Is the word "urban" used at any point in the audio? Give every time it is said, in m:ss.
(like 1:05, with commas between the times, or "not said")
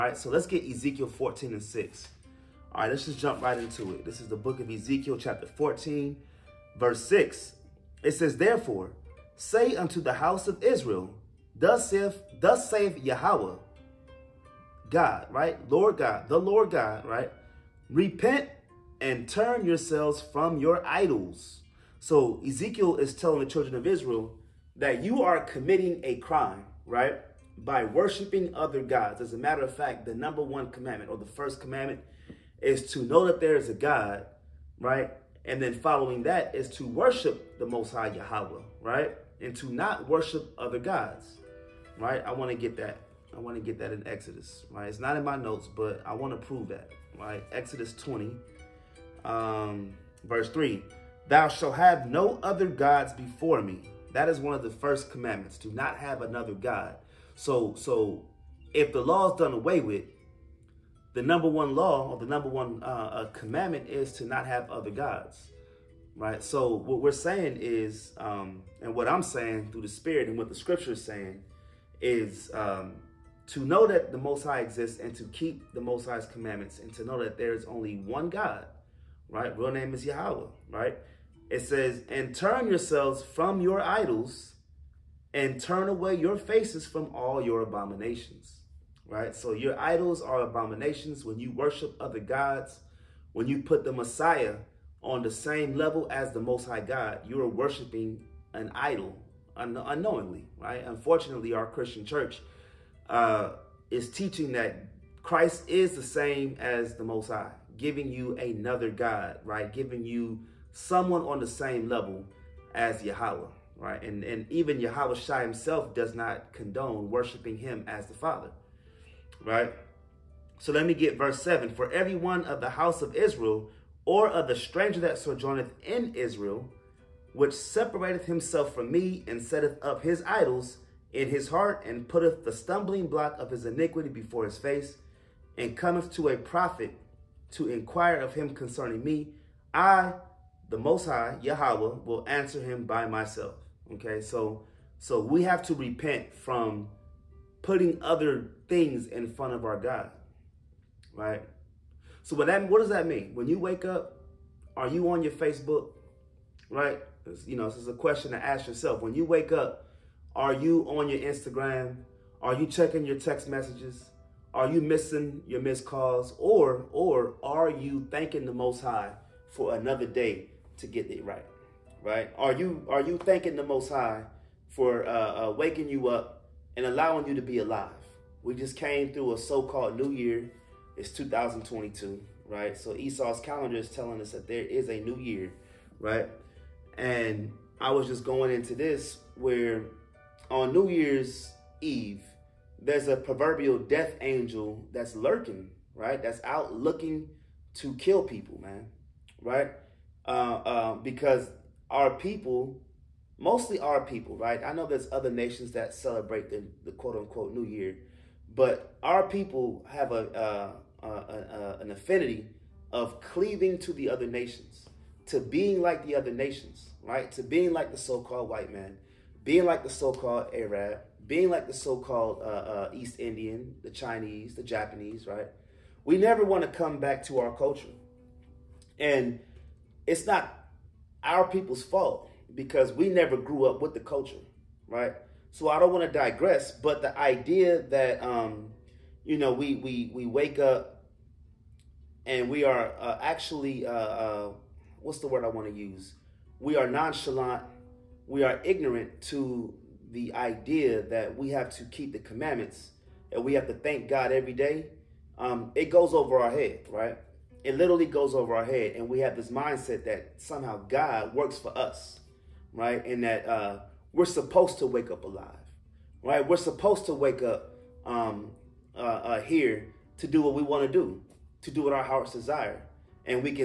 not said.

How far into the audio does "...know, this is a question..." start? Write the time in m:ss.
2:37.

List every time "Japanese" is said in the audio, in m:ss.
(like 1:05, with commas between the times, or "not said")
3:44.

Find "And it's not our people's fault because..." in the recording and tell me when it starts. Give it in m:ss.
3:48.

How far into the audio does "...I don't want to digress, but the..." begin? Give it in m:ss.
3:55.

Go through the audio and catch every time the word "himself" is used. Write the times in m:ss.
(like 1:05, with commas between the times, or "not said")
1:55, 2:08.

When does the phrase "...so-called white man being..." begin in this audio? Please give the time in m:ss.
3:37.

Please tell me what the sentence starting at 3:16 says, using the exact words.
That's out looking to kill people, man, right?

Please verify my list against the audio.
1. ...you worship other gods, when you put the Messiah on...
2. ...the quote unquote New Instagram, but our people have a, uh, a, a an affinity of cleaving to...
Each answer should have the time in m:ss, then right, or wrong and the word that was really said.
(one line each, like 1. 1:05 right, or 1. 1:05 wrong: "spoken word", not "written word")
1. 1:31 right
2. 3:26 wrong: "Year", not "Instagram".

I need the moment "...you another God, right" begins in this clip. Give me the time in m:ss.
1:48.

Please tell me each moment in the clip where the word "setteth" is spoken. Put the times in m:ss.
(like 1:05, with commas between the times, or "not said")
2:09.